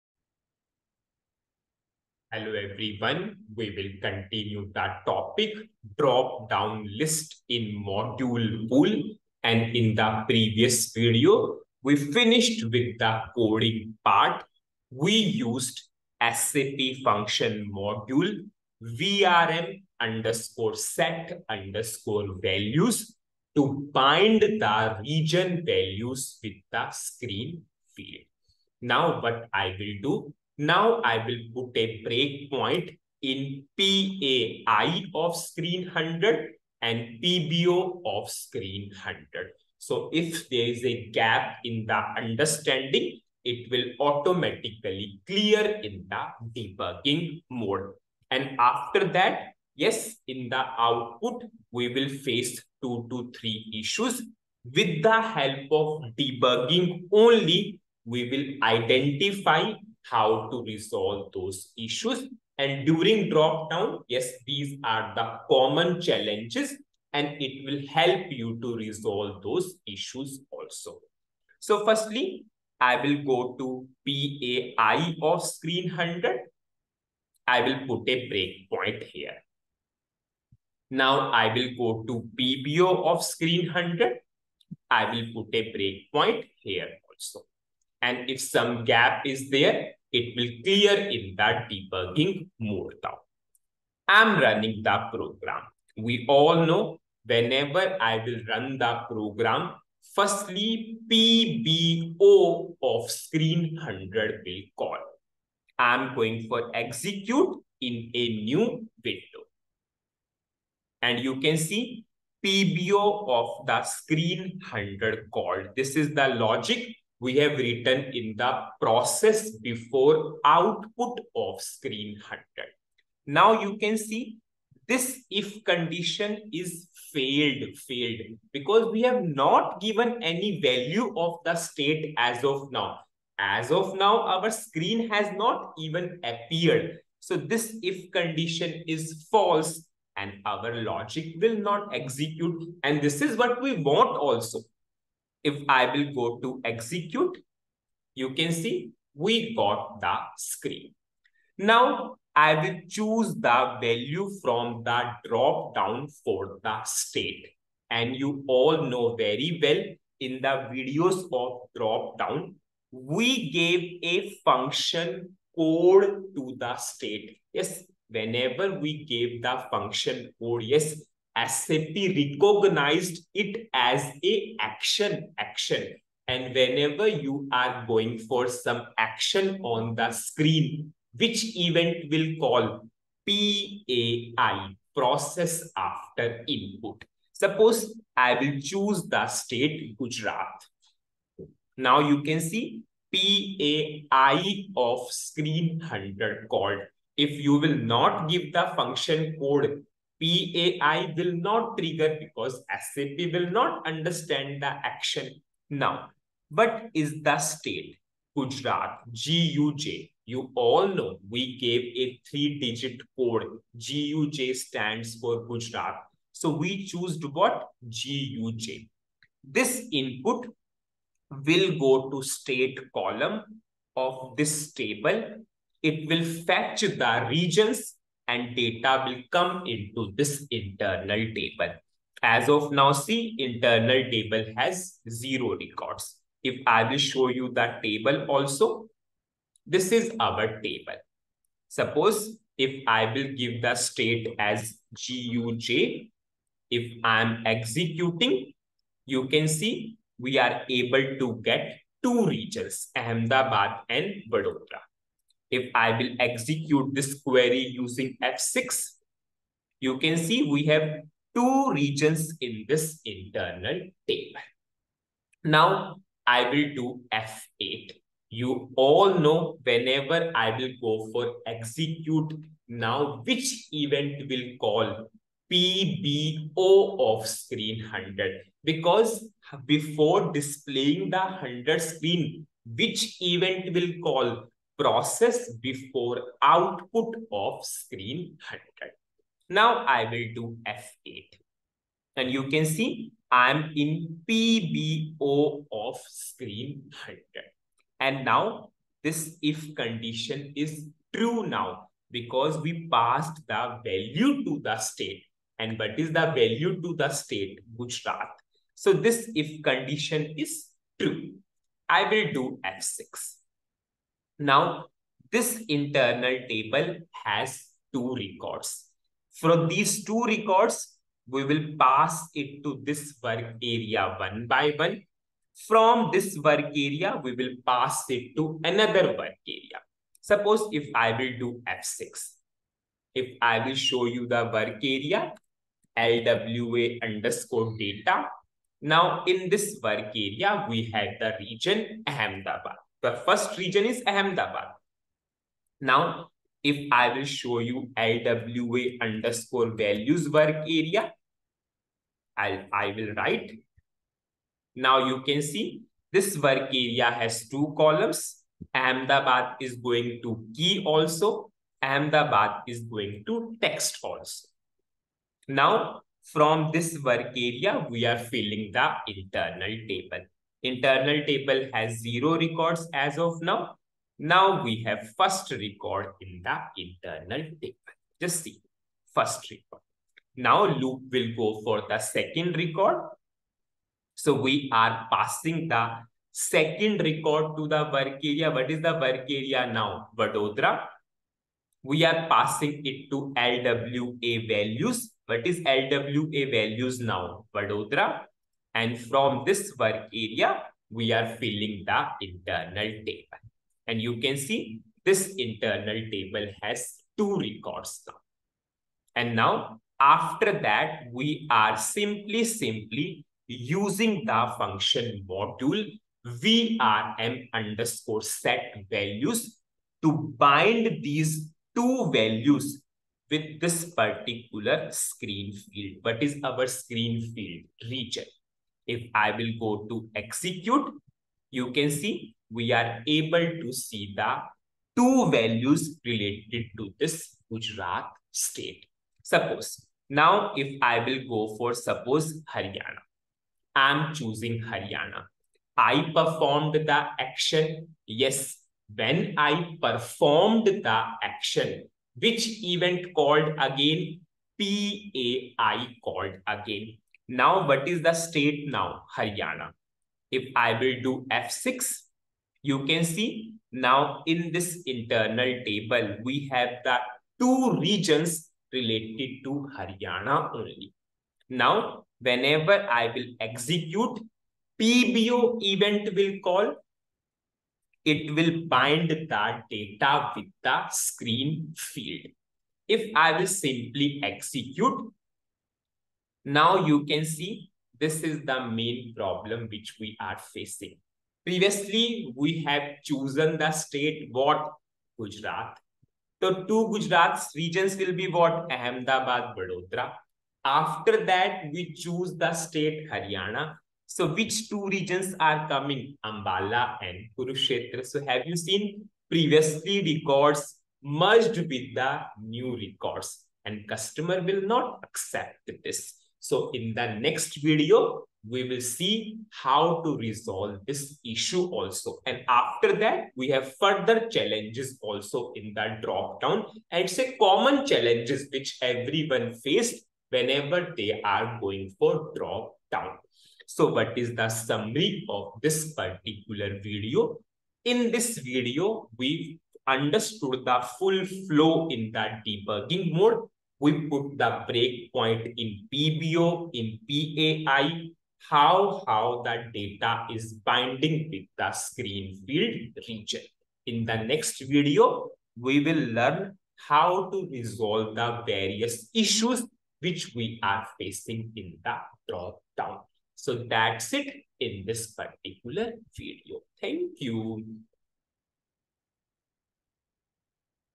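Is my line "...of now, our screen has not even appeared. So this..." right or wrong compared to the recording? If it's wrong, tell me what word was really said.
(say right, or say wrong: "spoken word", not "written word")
right.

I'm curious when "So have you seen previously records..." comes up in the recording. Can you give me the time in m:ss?
8:28.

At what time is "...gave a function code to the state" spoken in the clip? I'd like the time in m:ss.
2:43.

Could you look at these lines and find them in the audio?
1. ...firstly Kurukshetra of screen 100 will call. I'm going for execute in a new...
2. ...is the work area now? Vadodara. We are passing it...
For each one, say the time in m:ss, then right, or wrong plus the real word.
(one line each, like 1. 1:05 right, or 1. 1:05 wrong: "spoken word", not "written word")
1. 1:40 wrong: "PBO", not "Kurukshetra"
2. 6:28 right.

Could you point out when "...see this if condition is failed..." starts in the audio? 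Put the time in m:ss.
2:03.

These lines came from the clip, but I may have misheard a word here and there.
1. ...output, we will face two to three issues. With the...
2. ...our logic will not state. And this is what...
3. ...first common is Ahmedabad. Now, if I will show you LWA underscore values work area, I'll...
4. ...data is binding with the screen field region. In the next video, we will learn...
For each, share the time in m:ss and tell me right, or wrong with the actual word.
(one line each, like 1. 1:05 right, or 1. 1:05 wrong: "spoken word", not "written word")
1. 0:50 right
2. 2:20 wrong: "execute", not "state"
3. 5:43 wrong: "region", not "common"
4. 9:09 right.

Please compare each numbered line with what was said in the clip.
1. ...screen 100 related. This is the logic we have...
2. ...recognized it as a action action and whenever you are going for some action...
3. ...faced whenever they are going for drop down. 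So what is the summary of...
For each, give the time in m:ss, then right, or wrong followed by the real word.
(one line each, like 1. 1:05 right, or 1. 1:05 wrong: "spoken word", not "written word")
1. 1:53 wrong: "called", not "related"
2. 2:51 right
3. 8:49 right.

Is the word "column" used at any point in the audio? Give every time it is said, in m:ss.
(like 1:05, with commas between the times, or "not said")
3:42, 5:57.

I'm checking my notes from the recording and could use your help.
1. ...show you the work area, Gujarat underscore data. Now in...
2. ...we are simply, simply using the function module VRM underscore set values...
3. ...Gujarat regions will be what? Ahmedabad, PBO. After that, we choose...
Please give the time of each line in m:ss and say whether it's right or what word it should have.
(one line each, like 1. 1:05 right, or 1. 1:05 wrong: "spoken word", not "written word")
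1. 5:33 wrong: "LWA", not "Gujarat"
2. 6:51 right
3. 8:16 wrong: "Vadodara", not "PBO".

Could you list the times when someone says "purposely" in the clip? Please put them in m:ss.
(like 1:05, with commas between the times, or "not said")
not said.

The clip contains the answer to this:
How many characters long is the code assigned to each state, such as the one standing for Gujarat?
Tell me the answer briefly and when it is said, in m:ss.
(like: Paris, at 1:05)
3, at 3:32.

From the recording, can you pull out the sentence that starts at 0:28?
Now what I will do, now I will put a breakpoint in PAI of screen 100 and PBO of screen 100.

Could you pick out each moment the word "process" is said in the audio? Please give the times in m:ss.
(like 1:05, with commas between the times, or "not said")
1:58, 3:04, 4:44.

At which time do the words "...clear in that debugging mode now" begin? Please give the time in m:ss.
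1:30.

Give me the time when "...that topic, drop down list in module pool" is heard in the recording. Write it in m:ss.
0:04.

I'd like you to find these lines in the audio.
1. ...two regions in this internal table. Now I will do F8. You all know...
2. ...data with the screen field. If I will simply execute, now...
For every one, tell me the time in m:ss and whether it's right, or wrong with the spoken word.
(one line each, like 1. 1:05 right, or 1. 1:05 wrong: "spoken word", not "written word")
1. 4:21 right
2. 7:59 right.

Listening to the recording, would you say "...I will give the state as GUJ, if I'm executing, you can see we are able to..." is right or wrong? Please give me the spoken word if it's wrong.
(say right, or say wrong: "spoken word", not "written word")
right.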